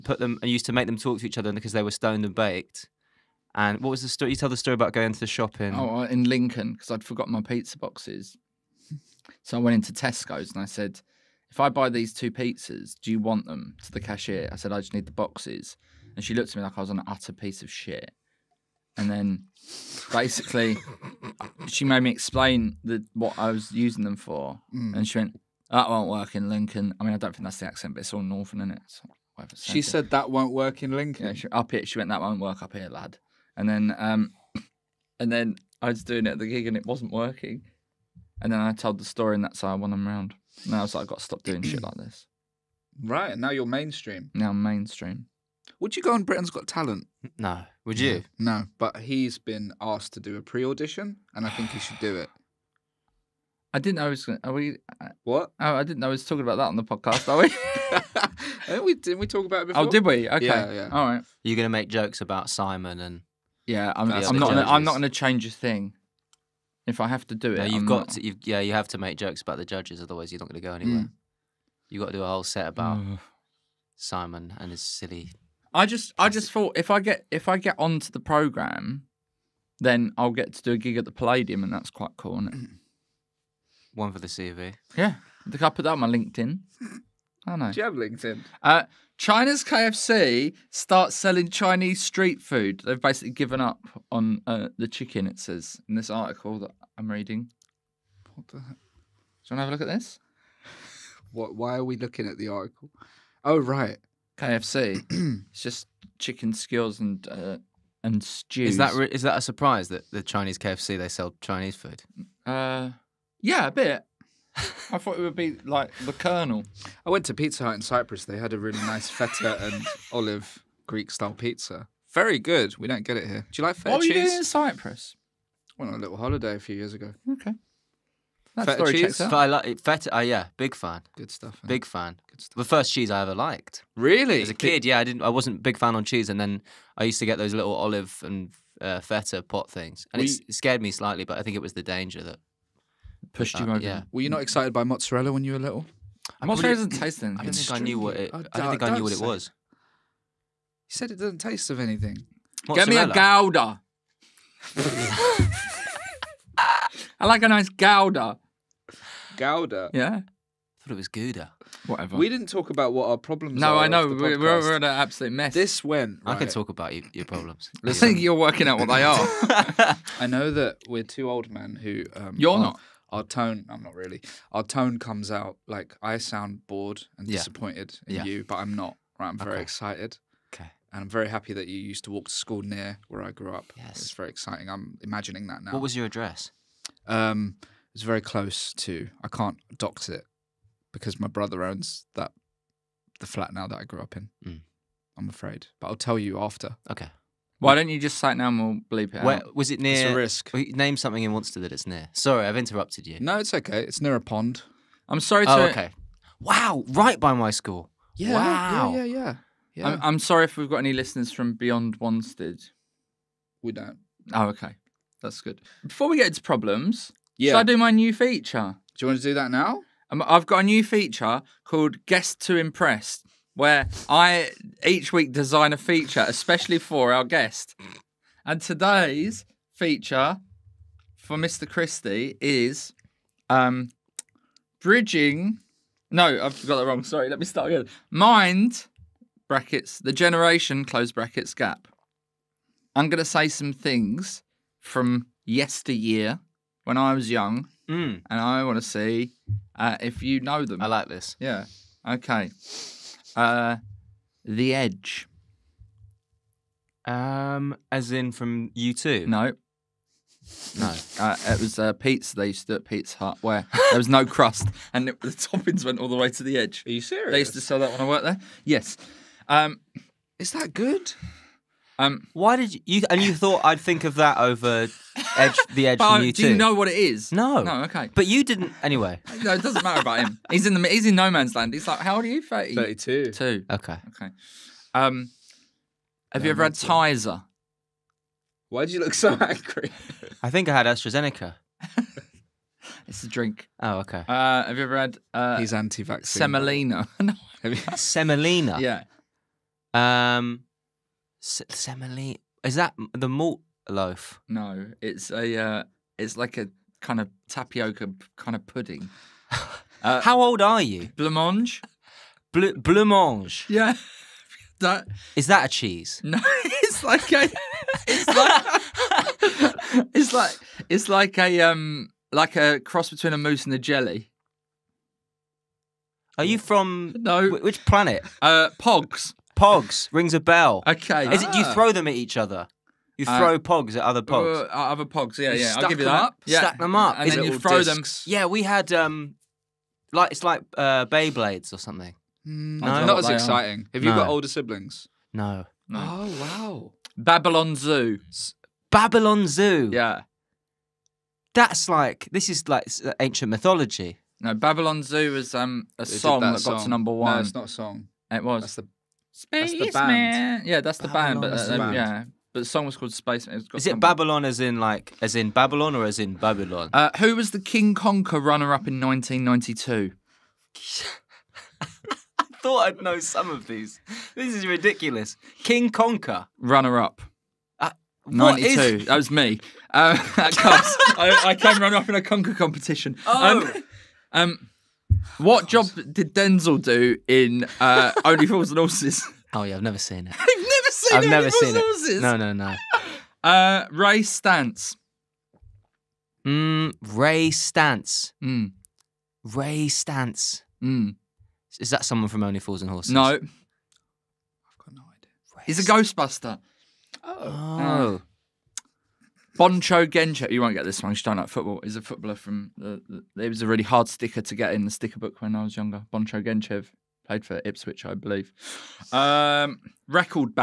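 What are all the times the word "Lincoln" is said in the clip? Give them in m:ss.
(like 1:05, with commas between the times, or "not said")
0:06, 0:26, 0:30.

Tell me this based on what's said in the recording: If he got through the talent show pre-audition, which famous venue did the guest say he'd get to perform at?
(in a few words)
the Palladium.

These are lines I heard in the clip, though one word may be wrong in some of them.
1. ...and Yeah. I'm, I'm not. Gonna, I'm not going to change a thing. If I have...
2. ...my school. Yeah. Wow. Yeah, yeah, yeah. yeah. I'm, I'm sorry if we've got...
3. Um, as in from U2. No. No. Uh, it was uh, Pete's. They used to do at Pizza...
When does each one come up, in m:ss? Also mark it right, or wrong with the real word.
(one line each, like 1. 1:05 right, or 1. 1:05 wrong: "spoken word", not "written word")
1. 1:03 right
2. 3:27 right
3. 4:17 right.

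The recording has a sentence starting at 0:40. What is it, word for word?
And I was like, I've got to stop doing shit like this.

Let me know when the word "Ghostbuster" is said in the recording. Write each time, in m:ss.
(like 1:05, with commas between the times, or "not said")
6:45.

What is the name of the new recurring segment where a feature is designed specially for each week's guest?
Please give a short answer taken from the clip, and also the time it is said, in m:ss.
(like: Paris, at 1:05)
Guest to Impress, at 3:42.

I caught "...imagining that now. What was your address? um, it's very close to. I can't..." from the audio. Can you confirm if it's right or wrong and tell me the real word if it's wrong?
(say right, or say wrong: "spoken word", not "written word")
right.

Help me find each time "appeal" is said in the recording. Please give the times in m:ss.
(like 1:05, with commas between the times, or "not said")
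not said.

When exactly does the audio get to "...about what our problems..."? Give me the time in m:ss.
2:42.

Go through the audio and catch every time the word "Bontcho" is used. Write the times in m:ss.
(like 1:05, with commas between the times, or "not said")
6:49, 6:56.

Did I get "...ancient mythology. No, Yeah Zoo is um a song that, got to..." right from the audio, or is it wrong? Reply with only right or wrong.
wrong.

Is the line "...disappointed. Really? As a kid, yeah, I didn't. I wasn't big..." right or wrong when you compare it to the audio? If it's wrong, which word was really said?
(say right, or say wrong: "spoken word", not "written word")
wrong: "liked", not "disappointed".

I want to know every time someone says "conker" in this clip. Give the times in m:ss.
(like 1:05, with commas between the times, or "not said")
6:07, 6:15, 6:22.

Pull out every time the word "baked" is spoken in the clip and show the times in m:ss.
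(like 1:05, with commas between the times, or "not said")
0:02.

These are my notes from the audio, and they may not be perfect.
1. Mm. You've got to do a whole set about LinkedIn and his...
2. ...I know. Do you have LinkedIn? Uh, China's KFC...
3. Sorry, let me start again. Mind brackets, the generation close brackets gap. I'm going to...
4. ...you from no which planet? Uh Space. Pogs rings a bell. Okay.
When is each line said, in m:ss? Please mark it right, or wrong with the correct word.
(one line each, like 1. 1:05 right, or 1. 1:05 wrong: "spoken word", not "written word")
1. 1:11 wrong: "Simon", not "LinkedIn"
2. 1:27 right
3. 3:57 right
4. 5:26 wrong: "Pogs", not "Space".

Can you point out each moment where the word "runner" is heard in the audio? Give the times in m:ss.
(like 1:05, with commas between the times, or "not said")
6:08, 6:16, 6:21.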